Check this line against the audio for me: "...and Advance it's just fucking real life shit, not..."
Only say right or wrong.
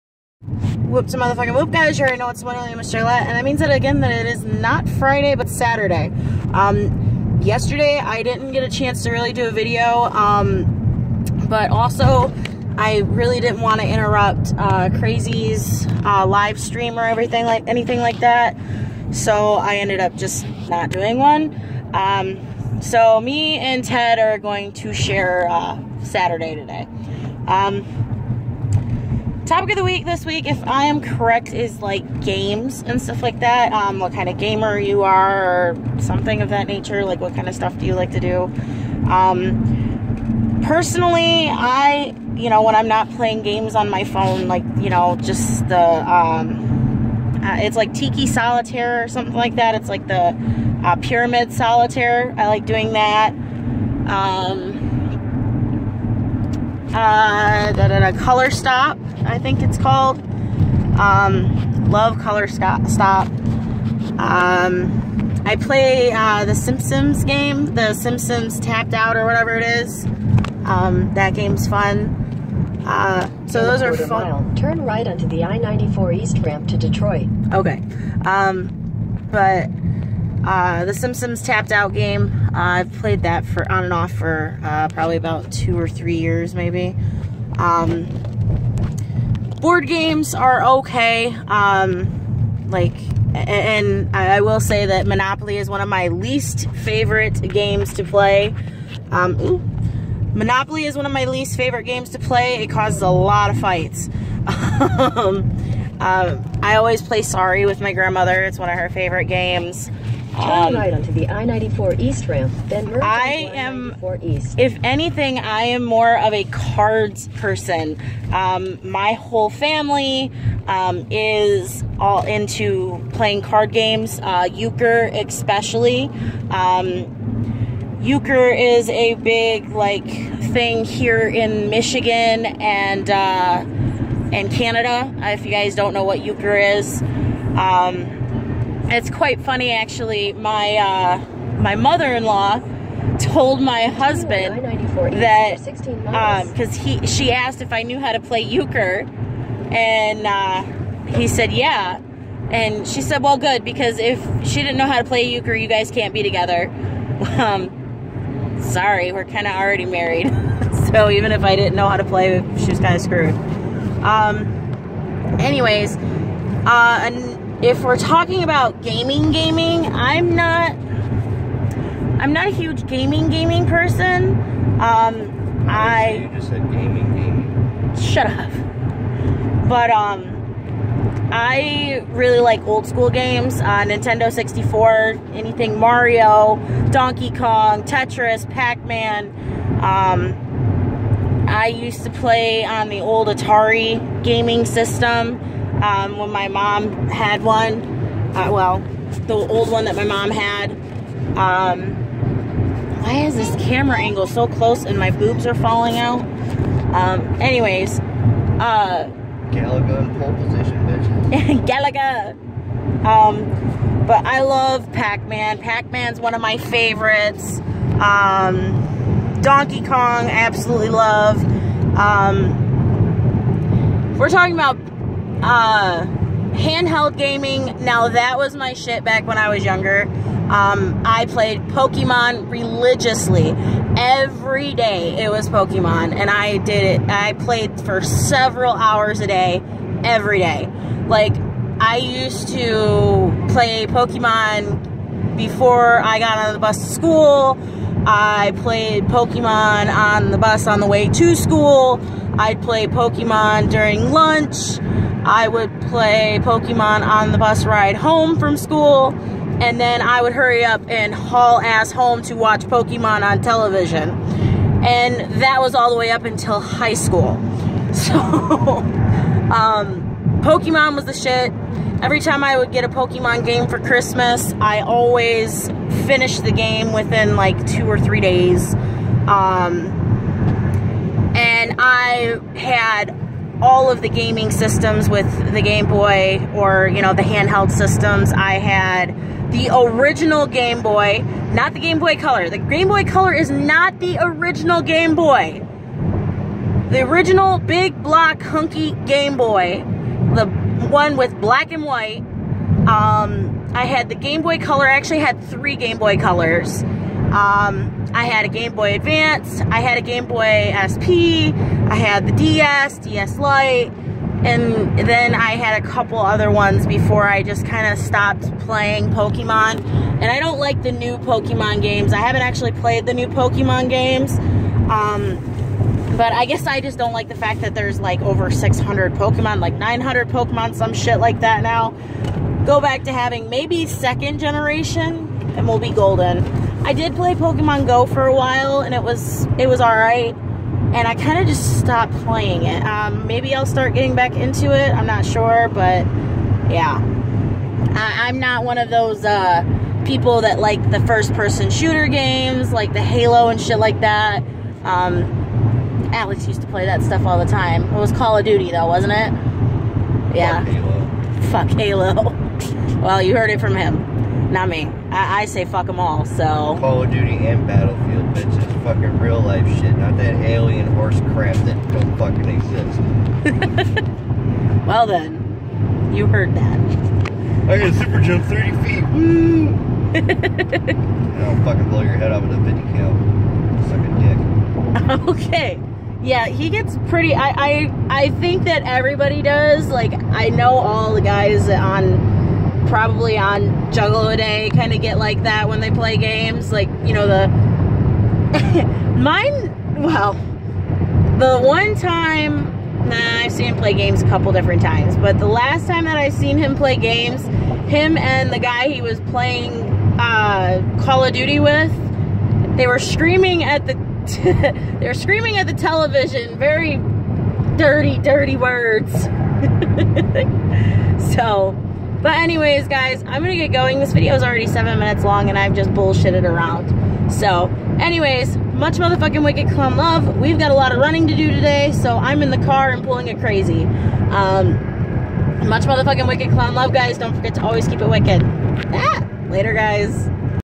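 wrong.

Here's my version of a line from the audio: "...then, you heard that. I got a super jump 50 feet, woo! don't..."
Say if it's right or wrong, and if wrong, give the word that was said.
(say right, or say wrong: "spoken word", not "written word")
wrong: "30", not "50".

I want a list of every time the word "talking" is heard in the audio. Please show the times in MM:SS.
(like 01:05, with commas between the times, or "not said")
02:47, 03:44.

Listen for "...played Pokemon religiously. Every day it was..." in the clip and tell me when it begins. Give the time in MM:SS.
03:51.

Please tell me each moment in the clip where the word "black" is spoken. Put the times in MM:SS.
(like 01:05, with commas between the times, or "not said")
05:01.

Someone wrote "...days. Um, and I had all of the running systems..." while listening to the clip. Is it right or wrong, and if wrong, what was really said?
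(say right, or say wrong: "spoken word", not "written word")
wrong: "gaming", not "running".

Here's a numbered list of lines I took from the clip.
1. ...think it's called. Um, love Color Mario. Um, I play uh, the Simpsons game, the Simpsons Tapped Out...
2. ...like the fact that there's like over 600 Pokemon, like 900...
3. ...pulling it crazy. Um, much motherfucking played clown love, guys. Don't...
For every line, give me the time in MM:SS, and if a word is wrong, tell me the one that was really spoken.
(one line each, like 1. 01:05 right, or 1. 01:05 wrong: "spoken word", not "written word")
1. 00:59 wrong: "Stop", not "Mario"
2. 05:27 right
3. 07:13 wrong: "wicked", not "played".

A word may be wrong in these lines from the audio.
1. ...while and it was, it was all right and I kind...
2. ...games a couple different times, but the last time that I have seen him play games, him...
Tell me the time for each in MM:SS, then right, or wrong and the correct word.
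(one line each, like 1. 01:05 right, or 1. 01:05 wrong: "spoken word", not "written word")
1. 05:38 right
2. 06:43 right.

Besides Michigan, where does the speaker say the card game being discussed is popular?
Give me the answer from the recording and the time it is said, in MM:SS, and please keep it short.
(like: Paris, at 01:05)
Canada, at 02:14.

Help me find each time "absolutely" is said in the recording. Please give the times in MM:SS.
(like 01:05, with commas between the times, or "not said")
03:40.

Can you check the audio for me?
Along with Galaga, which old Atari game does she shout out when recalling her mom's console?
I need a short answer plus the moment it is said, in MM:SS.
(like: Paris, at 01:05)
Pole Position, at 03:30.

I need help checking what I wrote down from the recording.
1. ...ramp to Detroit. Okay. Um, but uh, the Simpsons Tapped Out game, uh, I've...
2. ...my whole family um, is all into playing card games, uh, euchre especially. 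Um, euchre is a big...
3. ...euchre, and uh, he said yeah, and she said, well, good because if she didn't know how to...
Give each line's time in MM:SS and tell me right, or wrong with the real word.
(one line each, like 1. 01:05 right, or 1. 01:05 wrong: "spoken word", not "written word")
1. 01:16 right
2. 01:58 right
3. 02:28 right.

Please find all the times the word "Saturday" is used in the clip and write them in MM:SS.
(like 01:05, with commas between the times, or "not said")
00:05, 00:26.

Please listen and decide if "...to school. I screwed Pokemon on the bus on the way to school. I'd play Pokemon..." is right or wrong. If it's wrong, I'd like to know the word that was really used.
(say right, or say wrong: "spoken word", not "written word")
wrong: "played", not "screwed".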